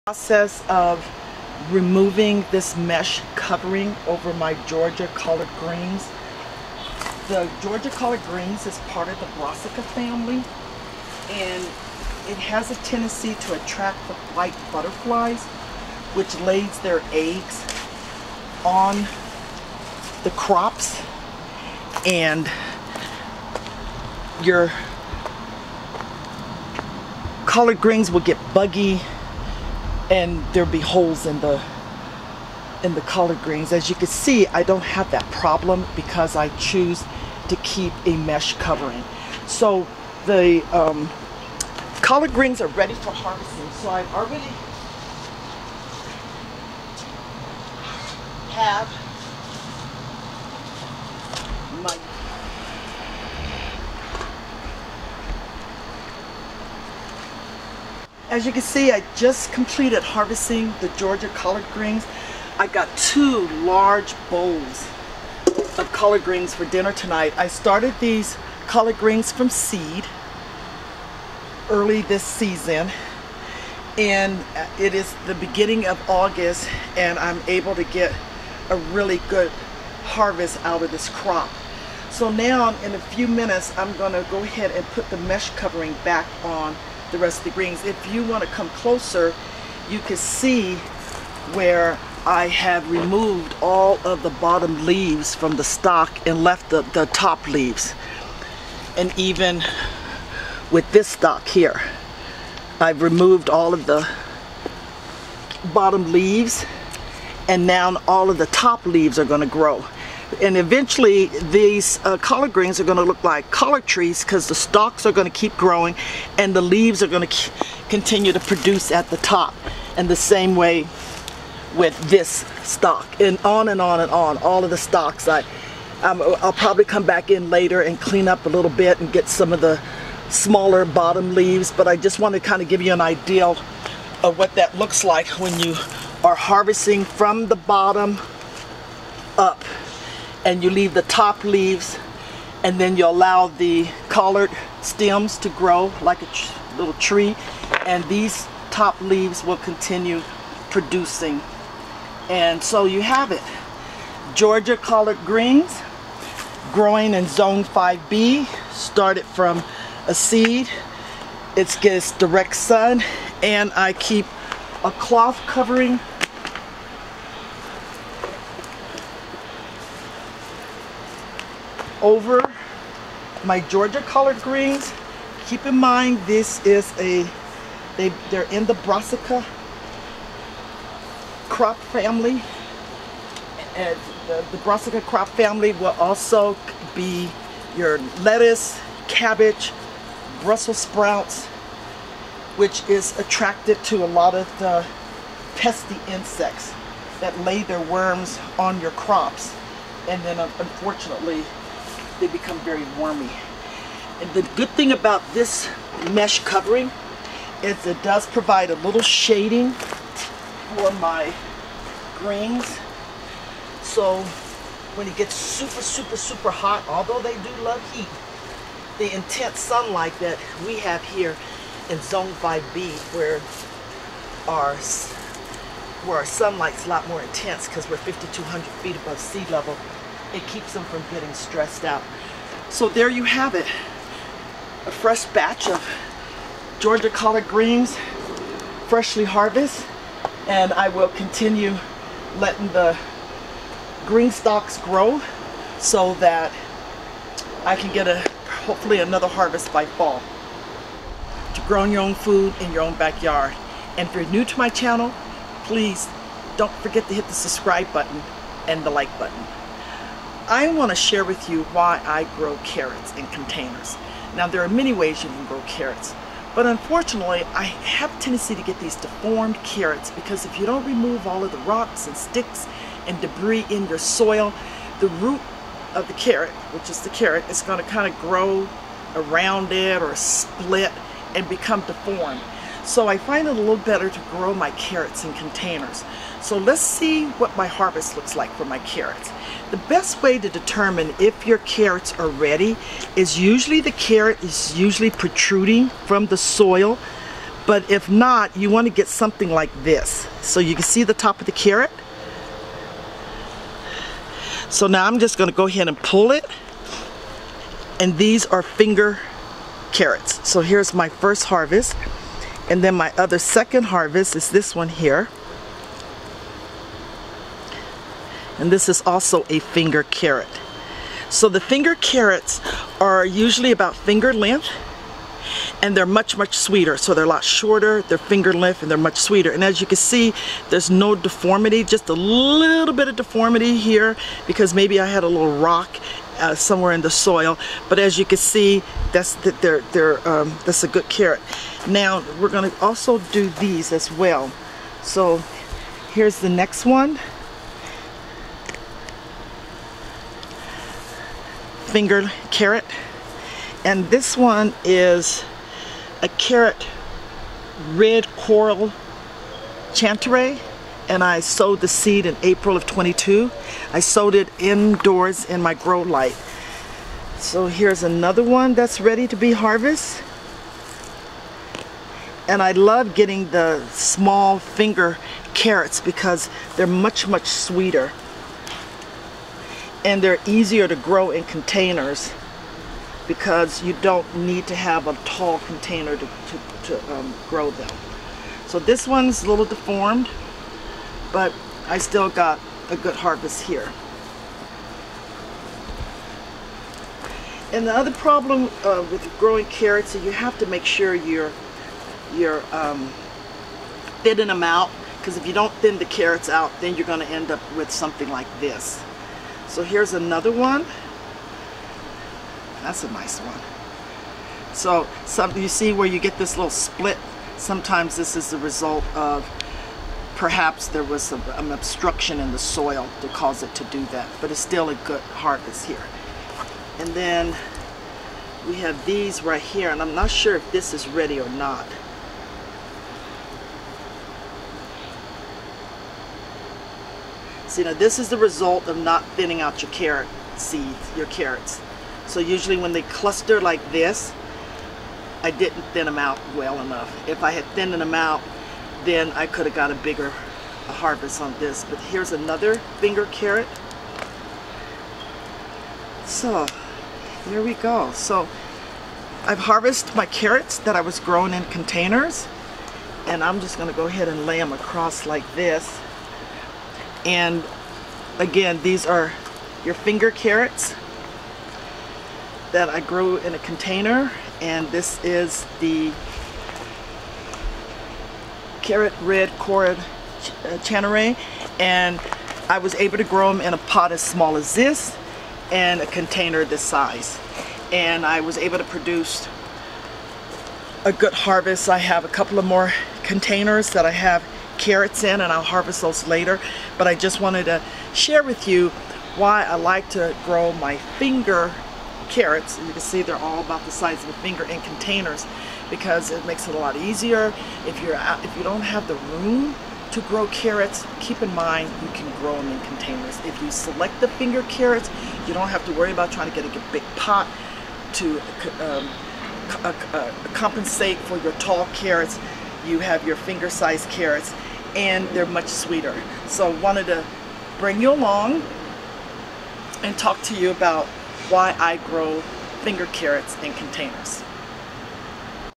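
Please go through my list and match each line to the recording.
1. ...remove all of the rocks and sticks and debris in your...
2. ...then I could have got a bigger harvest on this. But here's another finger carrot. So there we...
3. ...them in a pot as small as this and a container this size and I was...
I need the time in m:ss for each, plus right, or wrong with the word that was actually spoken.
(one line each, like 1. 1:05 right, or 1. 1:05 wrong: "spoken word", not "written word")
1. 4:30 right
2. 7:29 right
3. 8:03 right.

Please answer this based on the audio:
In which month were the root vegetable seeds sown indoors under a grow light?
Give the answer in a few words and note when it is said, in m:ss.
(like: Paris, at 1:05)
April, at 6:02.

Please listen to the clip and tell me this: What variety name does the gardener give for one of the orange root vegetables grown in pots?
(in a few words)
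Red Coral Chantenay.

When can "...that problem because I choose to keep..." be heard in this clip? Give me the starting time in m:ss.
0:35.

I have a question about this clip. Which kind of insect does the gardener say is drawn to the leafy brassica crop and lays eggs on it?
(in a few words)
White butterflies.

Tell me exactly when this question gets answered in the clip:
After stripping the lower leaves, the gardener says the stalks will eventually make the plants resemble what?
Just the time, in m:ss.
1:53.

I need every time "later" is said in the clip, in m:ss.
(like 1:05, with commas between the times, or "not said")
2:07, 8:16.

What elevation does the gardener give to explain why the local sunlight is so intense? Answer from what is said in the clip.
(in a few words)
5,200 feet.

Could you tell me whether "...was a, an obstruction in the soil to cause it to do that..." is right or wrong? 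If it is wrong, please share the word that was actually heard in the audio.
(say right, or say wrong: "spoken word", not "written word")
right.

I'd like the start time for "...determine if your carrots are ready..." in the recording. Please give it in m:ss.
4:50.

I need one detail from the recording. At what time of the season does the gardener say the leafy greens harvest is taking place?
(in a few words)
Beginning of August.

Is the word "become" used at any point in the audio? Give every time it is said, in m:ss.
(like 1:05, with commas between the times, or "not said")
3:22, 4:41.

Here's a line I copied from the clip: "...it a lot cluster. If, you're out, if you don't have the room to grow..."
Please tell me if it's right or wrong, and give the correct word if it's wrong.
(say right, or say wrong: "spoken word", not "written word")
wrong: "easier", not "cluster".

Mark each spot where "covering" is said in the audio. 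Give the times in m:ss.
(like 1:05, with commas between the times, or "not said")
0:03, 0:38, 1:25, 2:45, 3:26.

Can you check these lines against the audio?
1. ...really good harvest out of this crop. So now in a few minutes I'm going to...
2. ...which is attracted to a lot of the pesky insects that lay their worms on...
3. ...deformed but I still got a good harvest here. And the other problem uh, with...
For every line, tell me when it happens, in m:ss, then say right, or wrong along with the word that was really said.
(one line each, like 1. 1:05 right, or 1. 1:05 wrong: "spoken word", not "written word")
1. 1:18 right
2. 3:12 right
3. 6:29 right.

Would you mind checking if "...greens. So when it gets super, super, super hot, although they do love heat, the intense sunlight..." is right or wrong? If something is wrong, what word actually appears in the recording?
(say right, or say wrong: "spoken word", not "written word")
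right.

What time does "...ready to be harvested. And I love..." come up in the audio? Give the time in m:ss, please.
6:09.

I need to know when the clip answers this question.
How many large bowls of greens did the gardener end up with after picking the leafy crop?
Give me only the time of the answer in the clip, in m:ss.
1:02.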